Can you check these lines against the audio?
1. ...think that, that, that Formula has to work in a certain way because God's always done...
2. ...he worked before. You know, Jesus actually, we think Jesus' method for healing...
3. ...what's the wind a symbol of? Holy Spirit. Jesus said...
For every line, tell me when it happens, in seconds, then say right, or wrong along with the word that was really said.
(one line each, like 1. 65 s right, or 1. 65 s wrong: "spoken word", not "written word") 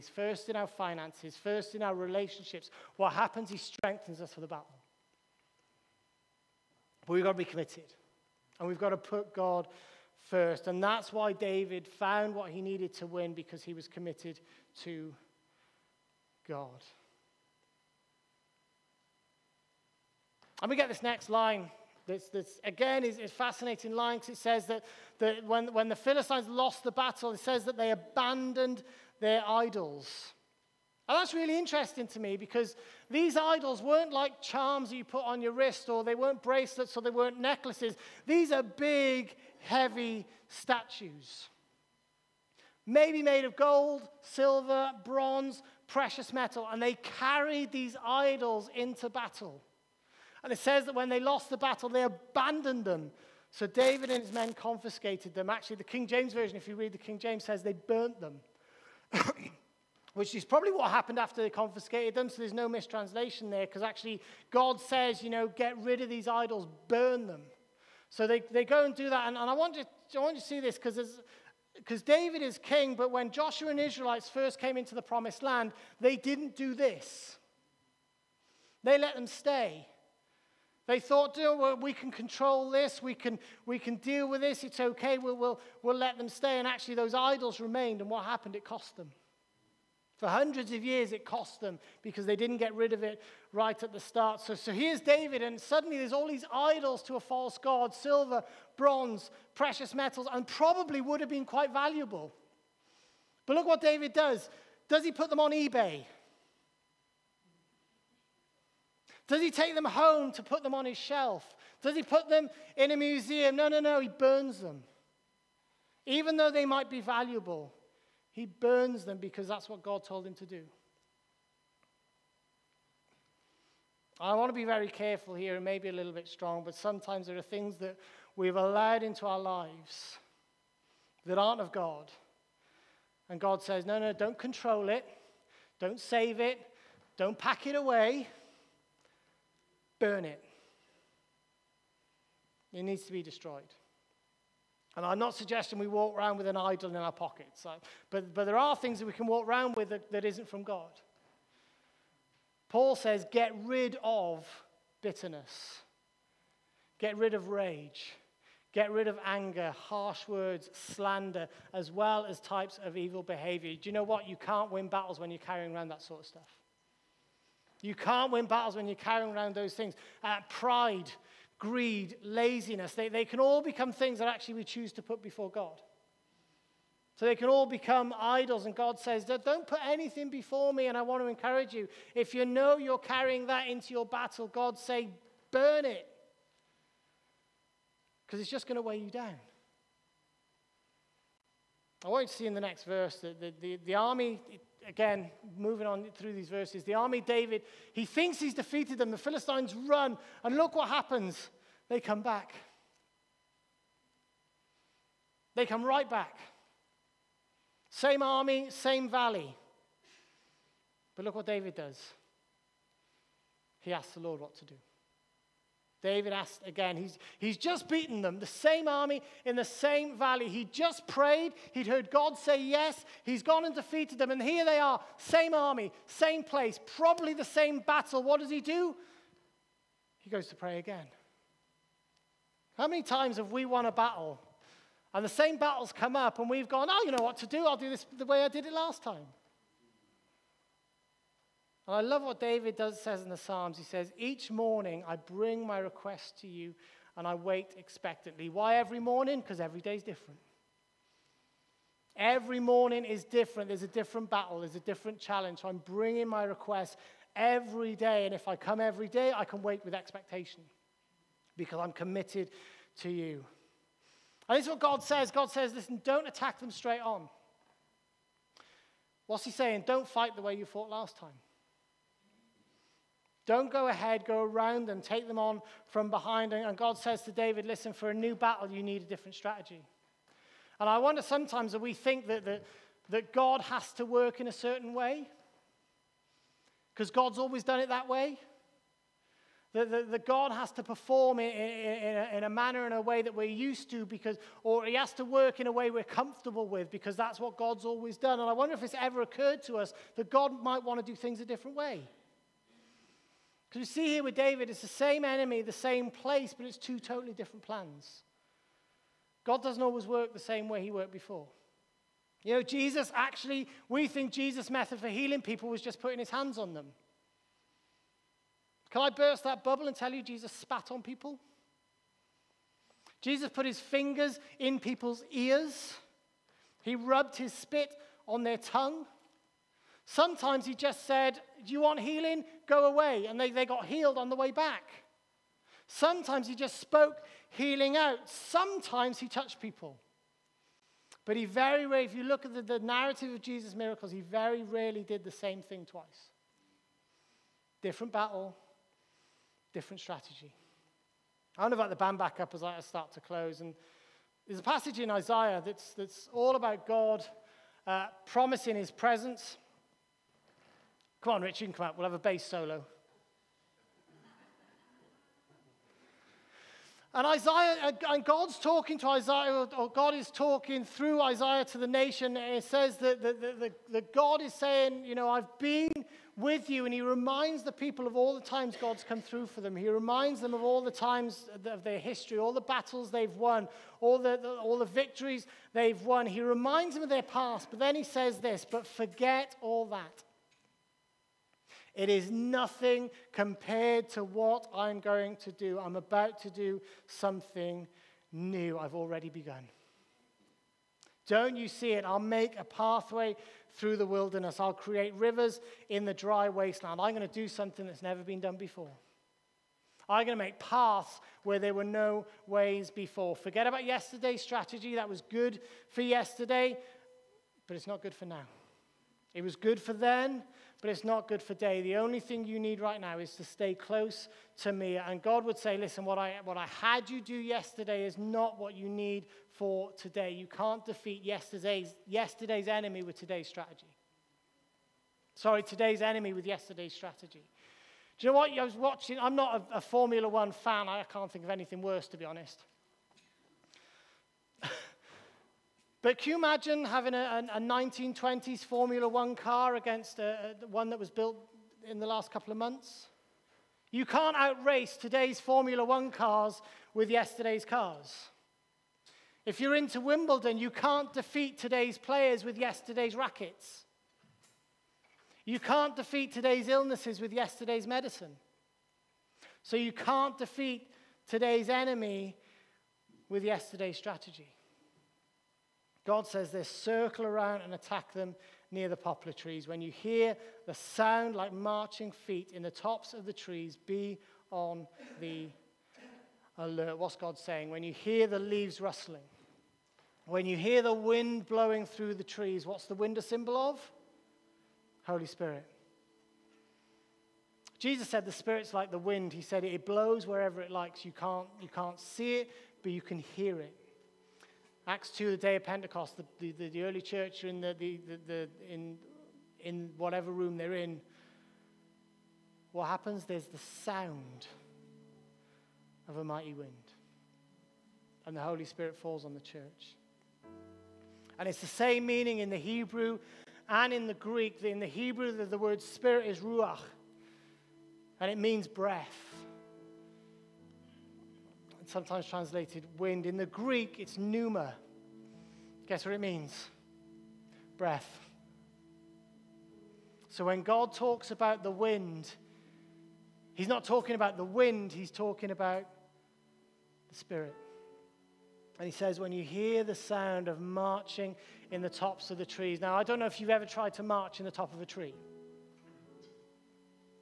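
1. 281 s wrong: "God", not "Formula"
2. 310 s right
3. 492 s right.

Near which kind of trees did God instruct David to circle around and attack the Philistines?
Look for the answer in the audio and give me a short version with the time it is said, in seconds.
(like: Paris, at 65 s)
Poplar trees, at 478 s.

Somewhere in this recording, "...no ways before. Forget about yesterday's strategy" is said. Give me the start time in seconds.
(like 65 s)
411 s.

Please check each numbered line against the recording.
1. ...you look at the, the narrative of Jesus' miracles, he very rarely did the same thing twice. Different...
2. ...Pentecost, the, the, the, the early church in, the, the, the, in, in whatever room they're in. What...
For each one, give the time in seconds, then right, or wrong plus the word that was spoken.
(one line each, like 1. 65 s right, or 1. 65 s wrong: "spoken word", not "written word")
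1. 342 s right
2. 505 s right.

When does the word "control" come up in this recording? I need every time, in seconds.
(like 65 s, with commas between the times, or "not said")
82 s, 134 s.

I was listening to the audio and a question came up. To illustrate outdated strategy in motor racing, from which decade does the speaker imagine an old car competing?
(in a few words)
1920s.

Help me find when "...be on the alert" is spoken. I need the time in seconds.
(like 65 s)
483 s.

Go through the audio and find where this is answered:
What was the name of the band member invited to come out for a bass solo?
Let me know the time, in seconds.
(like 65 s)
361 s.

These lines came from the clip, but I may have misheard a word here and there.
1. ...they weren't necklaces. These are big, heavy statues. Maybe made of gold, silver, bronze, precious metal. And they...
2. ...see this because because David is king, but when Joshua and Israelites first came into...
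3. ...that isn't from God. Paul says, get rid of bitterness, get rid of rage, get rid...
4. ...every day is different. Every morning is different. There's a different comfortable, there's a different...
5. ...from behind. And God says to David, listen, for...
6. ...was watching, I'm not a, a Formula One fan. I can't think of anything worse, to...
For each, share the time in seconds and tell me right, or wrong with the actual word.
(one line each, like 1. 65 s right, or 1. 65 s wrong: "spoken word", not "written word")
1. 37 s right
2. 70 s right
3. 150 s right
4. 249 s wrong: "battle", not "comfortable"
5. 275 s right
6. 438 s right.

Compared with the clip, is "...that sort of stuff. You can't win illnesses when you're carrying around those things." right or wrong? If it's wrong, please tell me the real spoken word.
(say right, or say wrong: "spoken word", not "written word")
wrong: "battles", not "illnesses".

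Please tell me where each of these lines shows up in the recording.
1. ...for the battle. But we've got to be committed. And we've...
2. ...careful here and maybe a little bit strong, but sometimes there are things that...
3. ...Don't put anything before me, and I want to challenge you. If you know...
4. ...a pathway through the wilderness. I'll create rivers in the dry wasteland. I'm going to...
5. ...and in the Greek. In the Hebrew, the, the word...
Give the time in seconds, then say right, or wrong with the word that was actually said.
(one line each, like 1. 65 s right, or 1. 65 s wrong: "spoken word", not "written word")
1. 4 s right
2. 124 s right
3. 179 s wrong: "encourage", not "challenge"
4. 402 s right
5. 523 s right.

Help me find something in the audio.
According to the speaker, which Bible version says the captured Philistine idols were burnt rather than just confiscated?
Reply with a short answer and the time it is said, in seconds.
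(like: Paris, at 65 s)
King James Version, at 55 s.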